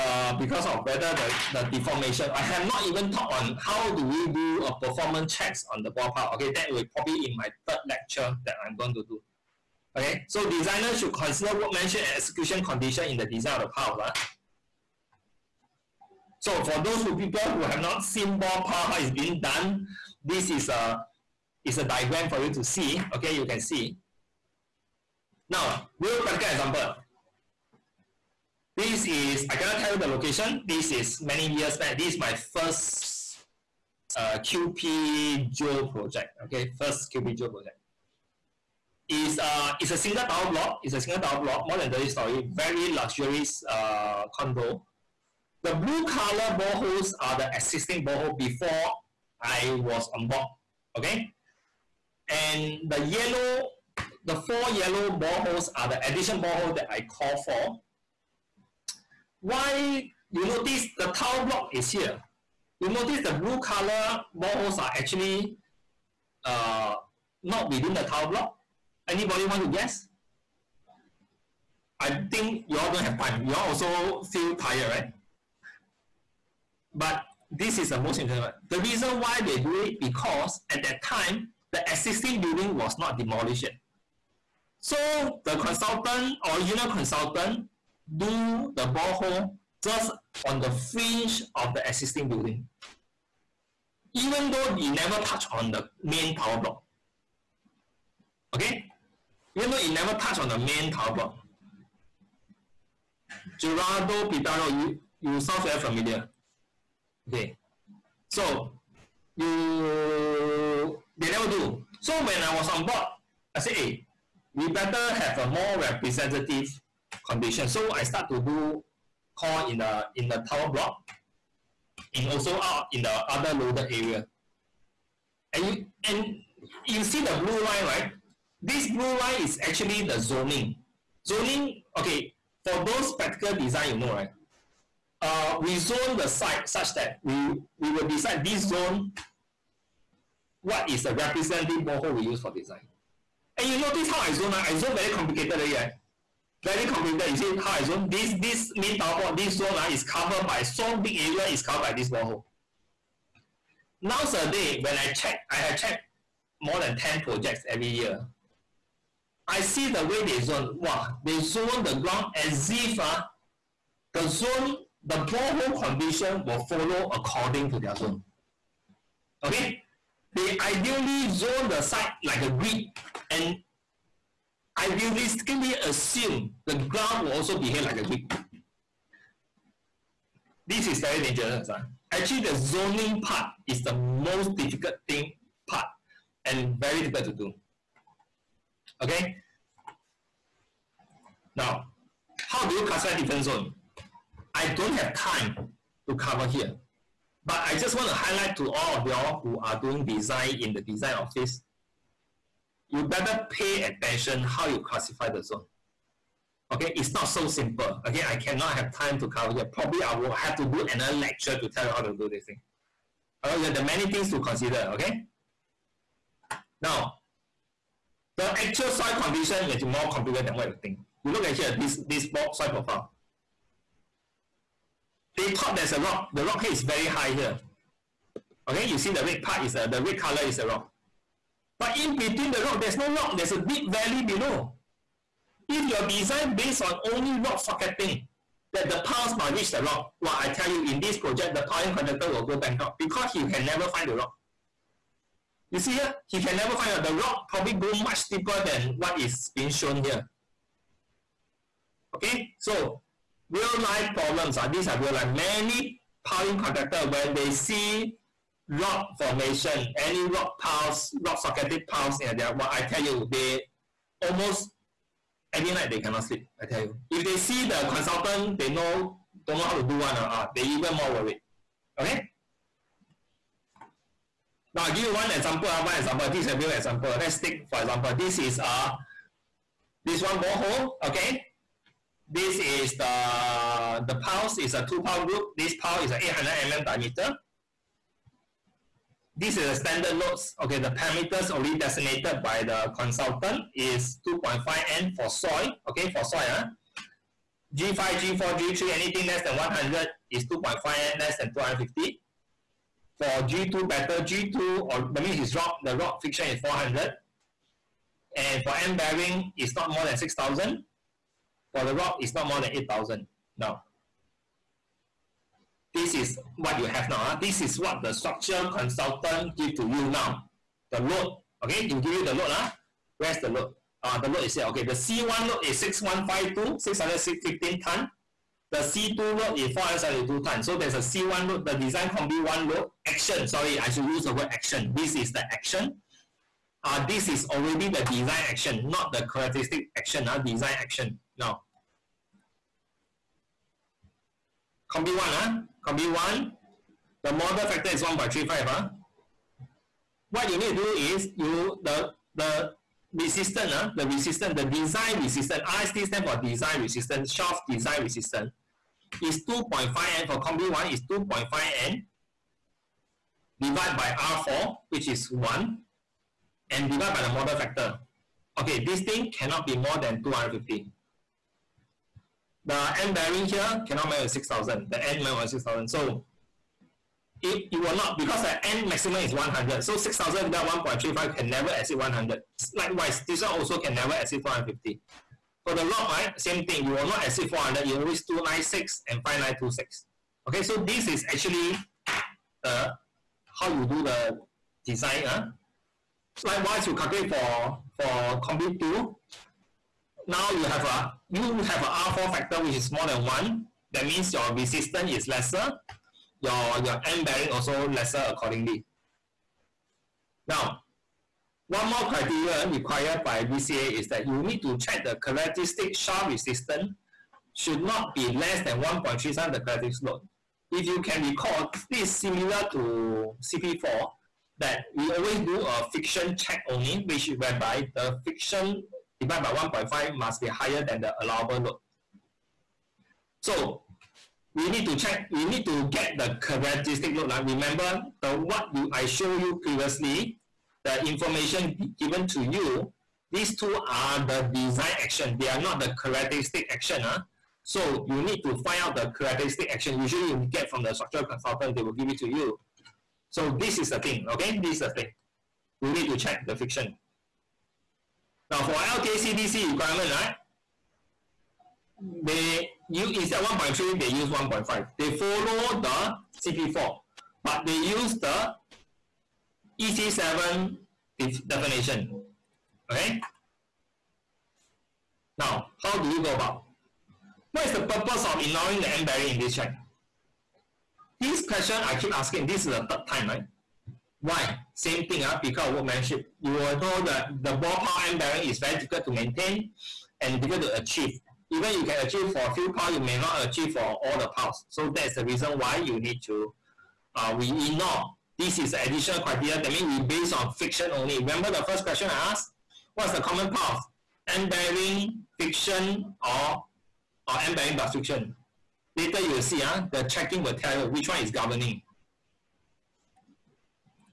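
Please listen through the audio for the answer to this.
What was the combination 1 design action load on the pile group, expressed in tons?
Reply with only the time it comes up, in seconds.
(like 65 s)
326 s.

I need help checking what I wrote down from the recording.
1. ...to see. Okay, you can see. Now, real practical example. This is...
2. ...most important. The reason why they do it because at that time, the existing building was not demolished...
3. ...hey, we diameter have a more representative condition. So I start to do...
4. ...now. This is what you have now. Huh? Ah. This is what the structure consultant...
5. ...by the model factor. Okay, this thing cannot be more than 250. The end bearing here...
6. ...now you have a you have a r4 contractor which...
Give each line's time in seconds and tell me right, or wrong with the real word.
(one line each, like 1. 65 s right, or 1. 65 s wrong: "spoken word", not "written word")
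1. 22 s right
2. 77 s right
3. 113 s wrong: "better", not "diameter"
4. 313 s right
5. 367 s right
6. 400 s wrong: "factor", not "contractor".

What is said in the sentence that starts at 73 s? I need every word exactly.
You all also feel tired, right?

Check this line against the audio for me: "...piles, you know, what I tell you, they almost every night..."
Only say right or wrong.
right.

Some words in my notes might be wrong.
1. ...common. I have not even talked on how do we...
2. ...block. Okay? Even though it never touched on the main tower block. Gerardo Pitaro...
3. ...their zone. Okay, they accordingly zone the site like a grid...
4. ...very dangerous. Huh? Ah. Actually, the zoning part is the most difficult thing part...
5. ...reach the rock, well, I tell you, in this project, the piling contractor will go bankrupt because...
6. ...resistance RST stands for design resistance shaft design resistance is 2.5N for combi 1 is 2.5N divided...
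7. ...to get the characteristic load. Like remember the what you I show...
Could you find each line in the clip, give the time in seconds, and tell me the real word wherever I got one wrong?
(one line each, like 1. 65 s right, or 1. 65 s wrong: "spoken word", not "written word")
1. 1 s wrong: "deformation", not "common"
2. 96 s right
3. 167 s wrong: "ideally", not "accordingly"
4. 180 s right
5. 239 s right
6. 355 s right
7. 435 s right.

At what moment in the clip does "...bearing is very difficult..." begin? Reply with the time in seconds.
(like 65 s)
488 s.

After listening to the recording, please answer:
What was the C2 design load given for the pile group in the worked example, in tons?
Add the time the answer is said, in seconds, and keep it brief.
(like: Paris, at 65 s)
472 ton, at 329 s.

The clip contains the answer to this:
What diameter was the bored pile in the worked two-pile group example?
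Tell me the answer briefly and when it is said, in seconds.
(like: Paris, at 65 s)
800 mm, at 286 s.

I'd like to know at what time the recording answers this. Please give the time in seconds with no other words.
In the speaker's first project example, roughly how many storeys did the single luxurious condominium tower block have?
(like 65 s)
41 s.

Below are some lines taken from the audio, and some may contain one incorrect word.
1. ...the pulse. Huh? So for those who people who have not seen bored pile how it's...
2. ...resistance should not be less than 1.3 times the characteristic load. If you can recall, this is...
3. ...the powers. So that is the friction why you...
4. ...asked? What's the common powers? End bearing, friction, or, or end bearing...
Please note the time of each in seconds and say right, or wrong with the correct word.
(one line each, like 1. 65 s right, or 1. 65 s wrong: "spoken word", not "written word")
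1. 13 s wrong: "house", not "pulse"
2. 416 s right
3. 494 s wrong: "reason", not "friction"
4. 502 s right.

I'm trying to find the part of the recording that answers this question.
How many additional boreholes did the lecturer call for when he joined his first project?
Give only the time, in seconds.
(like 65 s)
54 s.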